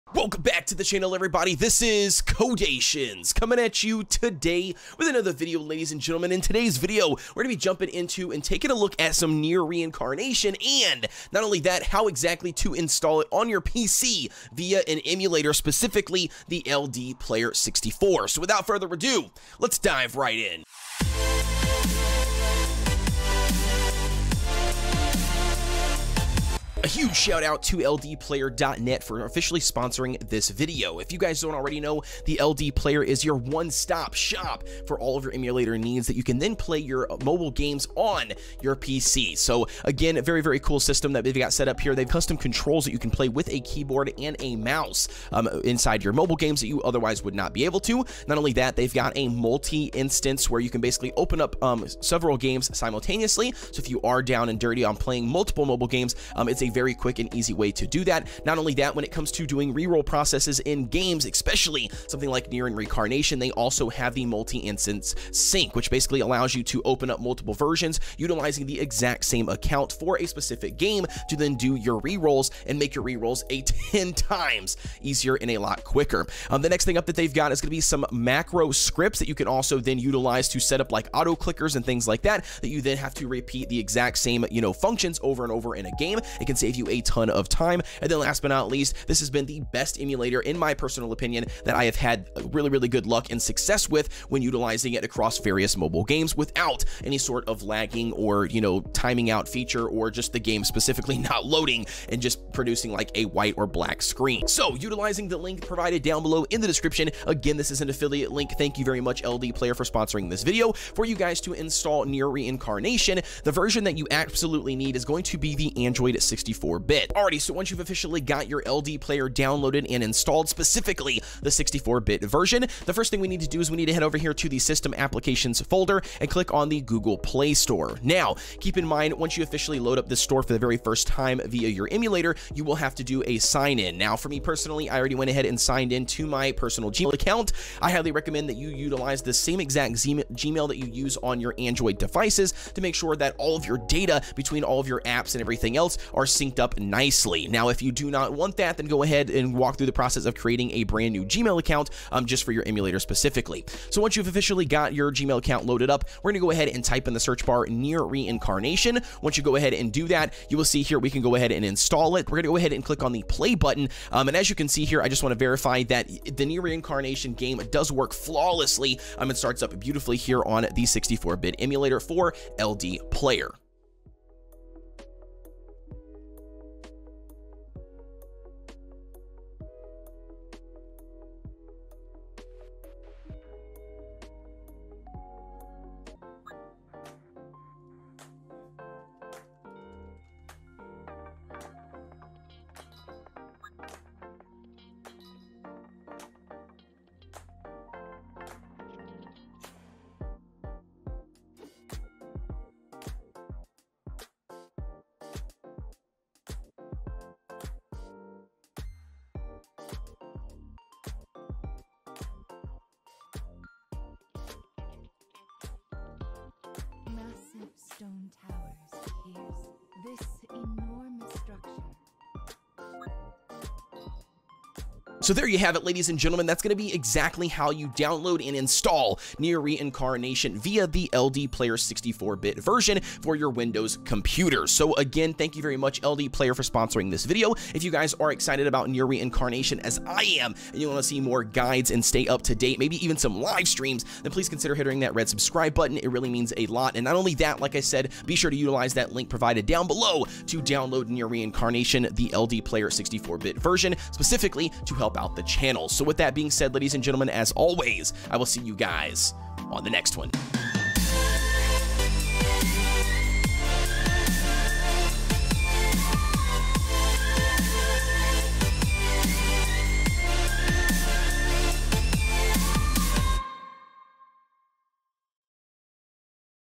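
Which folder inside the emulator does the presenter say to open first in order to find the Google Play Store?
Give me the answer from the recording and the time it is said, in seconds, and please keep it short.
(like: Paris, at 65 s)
System Applications, at 124 s.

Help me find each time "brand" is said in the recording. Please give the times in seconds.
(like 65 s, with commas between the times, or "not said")
150 s.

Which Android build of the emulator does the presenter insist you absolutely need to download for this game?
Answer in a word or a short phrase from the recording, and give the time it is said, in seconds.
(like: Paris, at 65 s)
Android 64-bit, at 115 s.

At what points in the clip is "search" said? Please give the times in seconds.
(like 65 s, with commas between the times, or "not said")
157 s.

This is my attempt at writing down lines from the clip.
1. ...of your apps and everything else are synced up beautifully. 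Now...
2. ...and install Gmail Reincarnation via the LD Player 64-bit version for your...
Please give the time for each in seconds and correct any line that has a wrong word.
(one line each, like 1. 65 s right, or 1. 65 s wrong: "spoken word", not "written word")
1. 144 s wrong: "nicely", not "beautifully"
2. 228 s wrong: "Nier", not "Gmail".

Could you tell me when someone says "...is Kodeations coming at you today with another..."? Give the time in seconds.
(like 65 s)
1 s.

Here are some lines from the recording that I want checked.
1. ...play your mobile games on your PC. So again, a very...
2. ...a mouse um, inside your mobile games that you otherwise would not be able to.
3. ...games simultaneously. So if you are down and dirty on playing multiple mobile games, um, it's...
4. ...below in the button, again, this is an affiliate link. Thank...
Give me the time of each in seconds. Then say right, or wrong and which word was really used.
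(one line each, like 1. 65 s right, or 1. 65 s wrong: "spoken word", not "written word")
1. 36 s right
2. 44 s right
3. 52 s right
4. 106 s wrong: "description", not "button".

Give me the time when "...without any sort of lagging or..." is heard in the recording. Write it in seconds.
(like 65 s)
96 s.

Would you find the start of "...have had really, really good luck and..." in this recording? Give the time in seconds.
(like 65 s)
91 s.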